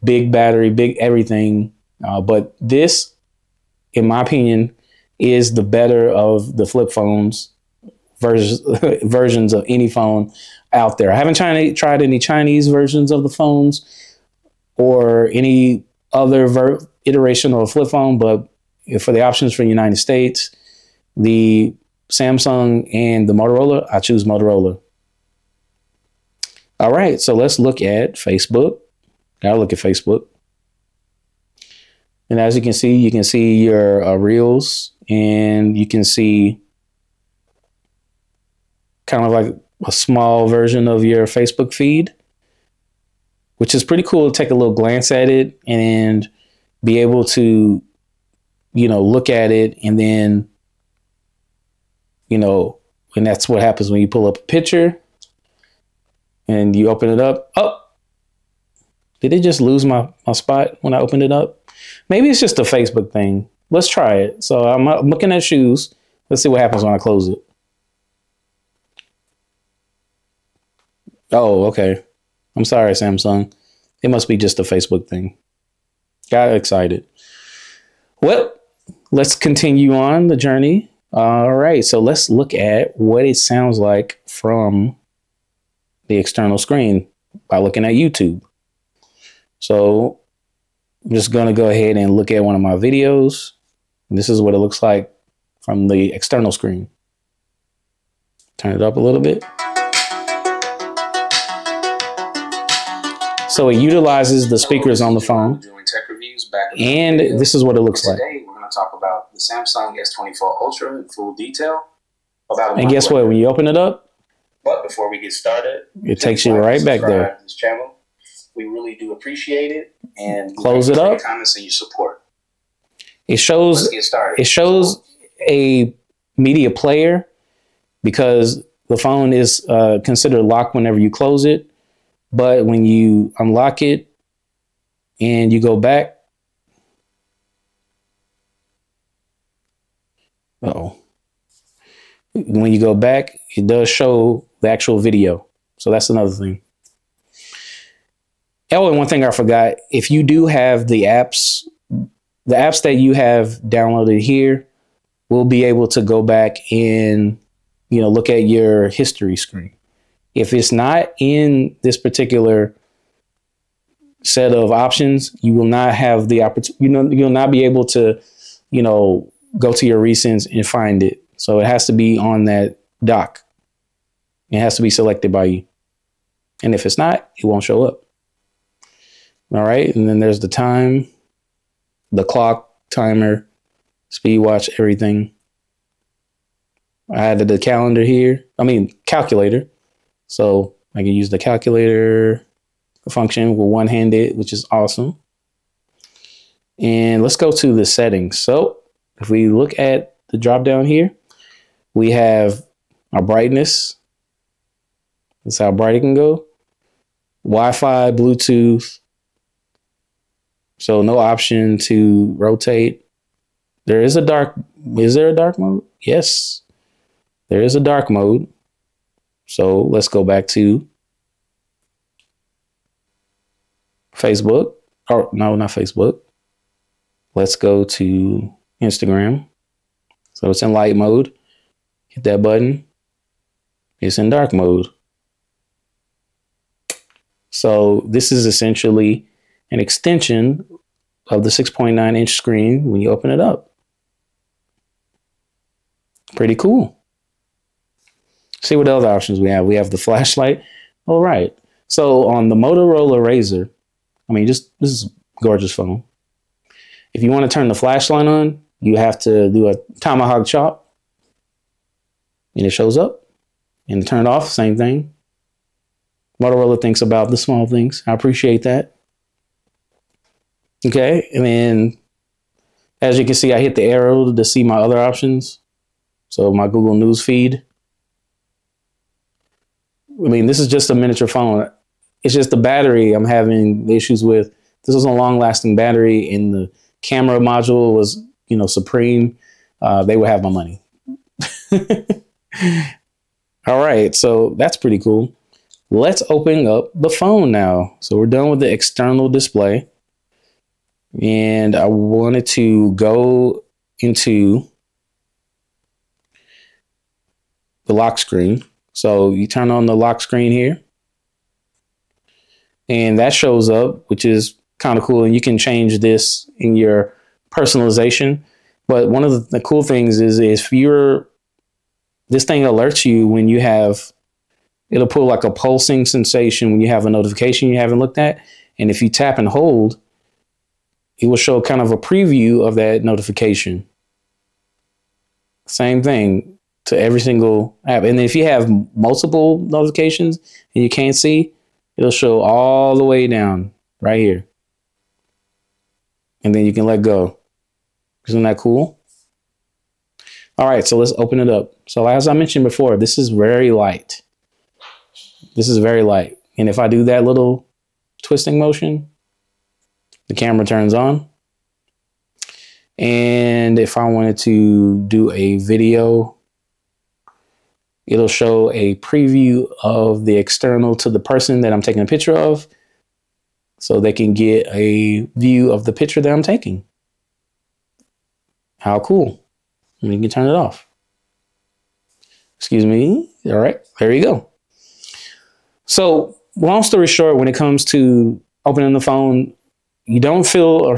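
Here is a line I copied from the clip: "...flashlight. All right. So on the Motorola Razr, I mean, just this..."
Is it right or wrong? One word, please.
right.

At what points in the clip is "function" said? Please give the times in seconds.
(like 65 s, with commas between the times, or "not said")
193 s.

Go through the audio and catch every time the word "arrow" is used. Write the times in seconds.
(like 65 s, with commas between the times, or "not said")
273 s.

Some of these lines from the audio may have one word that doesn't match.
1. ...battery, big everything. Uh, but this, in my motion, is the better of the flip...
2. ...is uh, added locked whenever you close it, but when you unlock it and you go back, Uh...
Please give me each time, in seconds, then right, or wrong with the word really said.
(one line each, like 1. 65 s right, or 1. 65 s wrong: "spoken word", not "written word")
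1. 0 s wrong: "opinion", not "motion"
2. 129 s wrong: "considered", not "added".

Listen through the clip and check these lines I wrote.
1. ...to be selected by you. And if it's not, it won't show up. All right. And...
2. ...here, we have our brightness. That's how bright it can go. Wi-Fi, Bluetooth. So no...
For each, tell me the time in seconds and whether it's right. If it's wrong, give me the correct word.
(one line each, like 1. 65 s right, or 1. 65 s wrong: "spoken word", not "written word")
1. 174 s right
2. 200 s right.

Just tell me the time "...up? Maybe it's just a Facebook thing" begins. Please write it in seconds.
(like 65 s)
61 s.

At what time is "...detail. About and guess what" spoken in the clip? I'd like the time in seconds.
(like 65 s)
111 s.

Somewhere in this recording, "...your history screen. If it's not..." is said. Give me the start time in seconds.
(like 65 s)
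158 s.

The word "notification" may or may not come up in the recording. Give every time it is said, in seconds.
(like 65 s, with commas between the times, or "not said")
327 s, 333 s, 339 s.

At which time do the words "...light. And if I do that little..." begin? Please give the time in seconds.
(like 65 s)
356 s.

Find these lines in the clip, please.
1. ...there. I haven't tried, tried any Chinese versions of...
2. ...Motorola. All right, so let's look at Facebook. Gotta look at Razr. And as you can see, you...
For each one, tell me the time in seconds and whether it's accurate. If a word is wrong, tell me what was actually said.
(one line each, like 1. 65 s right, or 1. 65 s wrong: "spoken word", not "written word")
1. 10 s right
2. 24 s wrong: "Facebook", not "Razr".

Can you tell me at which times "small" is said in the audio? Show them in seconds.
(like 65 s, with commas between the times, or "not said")
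39 s, 267 s.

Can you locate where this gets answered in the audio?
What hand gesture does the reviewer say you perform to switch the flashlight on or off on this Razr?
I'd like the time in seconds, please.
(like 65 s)
260 s.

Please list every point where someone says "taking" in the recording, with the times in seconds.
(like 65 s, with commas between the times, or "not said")
371 s, 376 s.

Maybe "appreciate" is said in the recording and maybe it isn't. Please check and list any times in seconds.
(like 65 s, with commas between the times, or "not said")
119 s, 268 s.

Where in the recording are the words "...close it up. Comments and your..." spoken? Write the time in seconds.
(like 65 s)
120 s.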